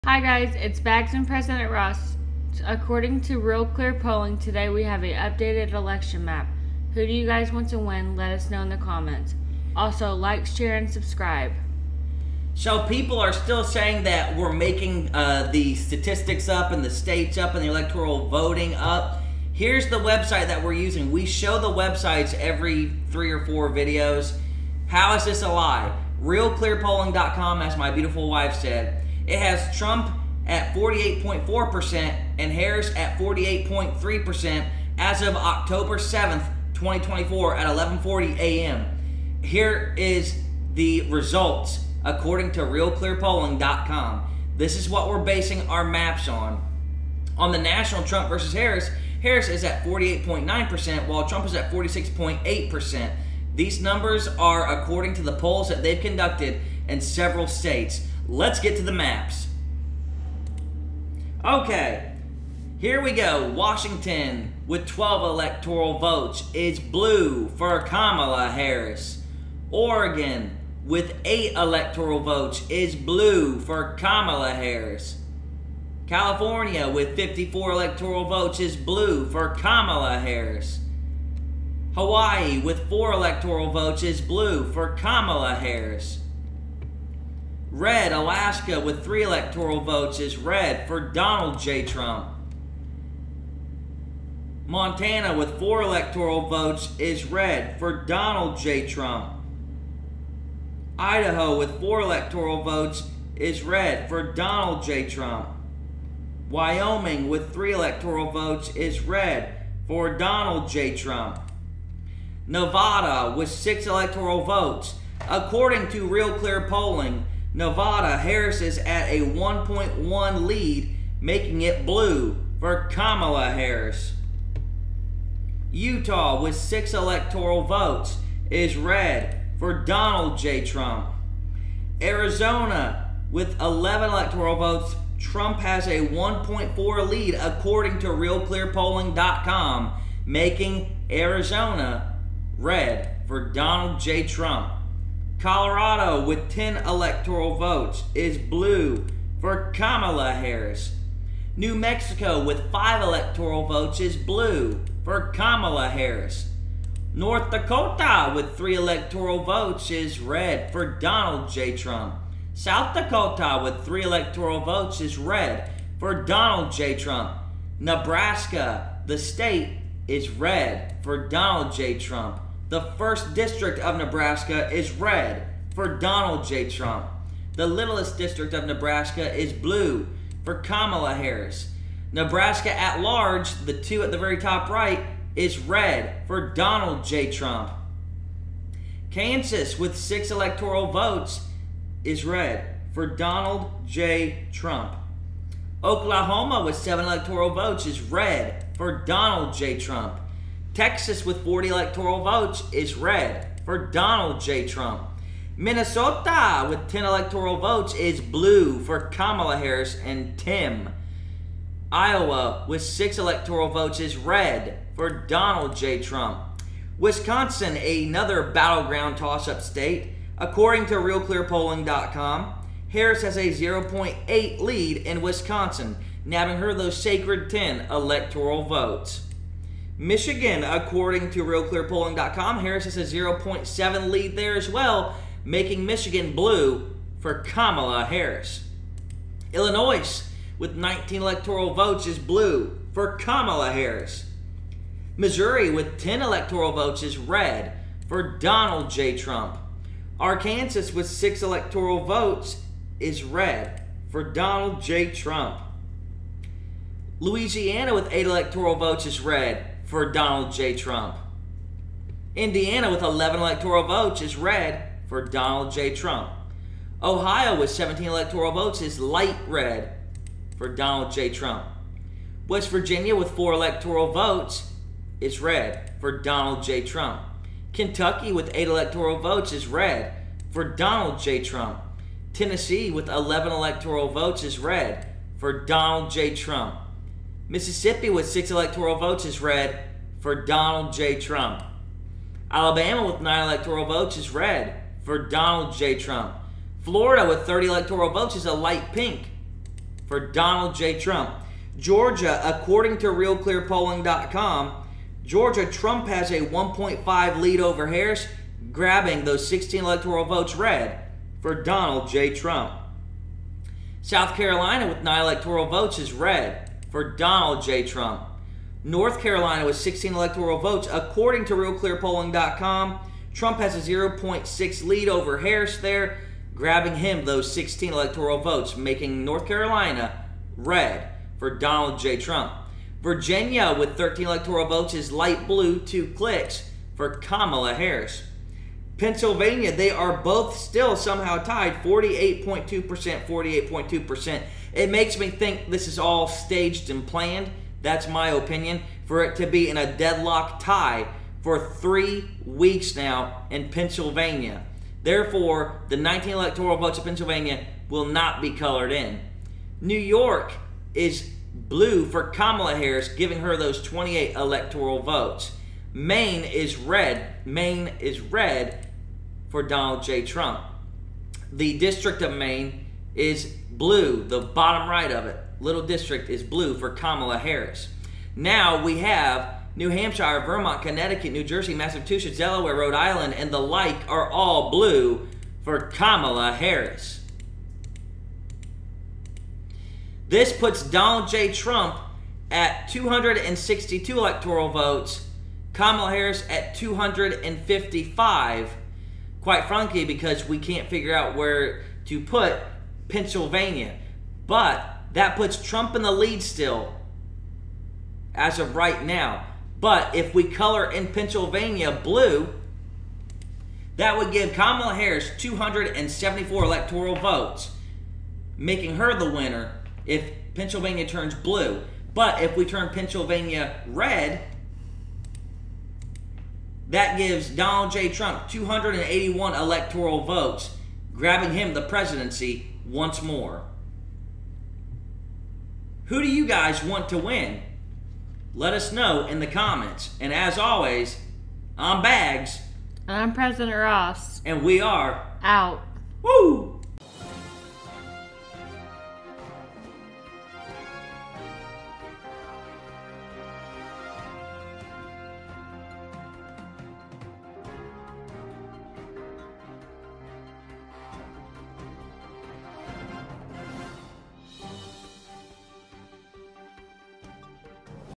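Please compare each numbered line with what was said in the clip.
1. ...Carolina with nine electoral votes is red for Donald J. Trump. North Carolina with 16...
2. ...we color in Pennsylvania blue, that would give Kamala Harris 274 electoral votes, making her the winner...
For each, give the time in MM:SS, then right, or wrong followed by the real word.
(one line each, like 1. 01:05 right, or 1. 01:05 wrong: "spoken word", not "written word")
1. 05:14 right
2. 06:50 right.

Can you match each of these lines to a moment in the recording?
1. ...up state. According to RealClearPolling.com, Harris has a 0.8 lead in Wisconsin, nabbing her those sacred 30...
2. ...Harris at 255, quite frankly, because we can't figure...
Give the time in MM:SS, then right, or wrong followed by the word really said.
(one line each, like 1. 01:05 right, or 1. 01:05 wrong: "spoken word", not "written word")
1. 03:39 wrong: "10", not "30"
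2. 06:36 right.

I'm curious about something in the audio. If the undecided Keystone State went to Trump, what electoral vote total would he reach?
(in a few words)
281.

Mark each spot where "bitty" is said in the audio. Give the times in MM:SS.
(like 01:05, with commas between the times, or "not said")
not said.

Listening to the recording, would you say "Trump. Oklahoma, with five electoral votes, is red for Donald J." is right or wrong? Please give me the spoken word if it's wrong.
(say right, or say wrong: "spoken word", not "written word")
wrong: "seven", not "five".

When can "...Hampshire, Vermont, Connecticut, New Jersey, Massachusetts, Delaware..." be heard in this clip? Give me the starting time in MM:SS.
06:19.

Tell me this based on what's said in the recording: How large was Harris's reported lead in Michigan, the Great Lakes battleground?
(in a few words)
0.7.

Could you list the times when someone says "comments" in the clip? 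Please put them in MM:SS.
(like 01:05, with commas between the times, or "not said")
00:08, 07:19.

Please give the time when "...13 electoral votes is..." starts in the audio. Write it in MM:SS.
05:33.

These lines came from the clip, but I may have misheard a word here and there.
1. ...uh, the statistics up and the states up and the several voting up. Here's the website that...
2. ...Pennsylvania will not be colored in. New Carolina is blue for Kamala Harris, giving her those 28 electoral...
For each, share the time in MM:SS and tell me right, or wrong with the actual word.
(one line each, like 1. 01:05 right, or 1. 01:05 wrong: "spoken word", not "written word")
1. 00:15 wrong: "electoral", not "several"
2. 05:57 wrong: "York", not "Carolina".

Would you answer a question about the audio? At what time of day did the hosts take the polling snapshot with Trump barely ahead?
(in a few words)
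11:40 a.m.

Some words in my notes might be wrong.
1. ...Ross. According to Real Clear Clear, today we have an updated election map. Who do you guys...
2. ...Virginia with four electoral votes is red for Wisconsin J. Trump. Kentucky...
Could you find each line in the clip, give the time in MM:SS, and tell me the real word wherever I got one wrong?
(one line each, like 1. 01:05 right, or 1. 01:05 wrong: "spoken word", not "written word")
1. 00:01 wrong: "Polling", not "Clear"
2. 04:32 wrong: "Donald", not "Wisconsin".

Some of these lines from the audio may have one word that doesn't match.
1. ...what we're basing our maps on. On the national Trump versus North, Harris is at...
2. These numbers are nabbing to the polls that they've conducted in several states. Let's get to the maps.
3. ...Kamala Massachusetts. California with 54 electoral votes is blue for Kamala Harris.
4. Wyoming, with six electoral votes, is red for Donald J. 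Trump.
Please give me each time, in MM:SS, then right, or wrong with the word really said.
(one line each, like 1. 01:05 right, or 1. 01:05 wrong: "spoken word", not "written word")
1. 00:44 wrong: "Harris", not "North"
2. 00:53 wrong: "according", not "nabbing"
3. 01:13 wrong: "Harris", not "Massachusetts"
4. 01:46 wrong: "three", not "six".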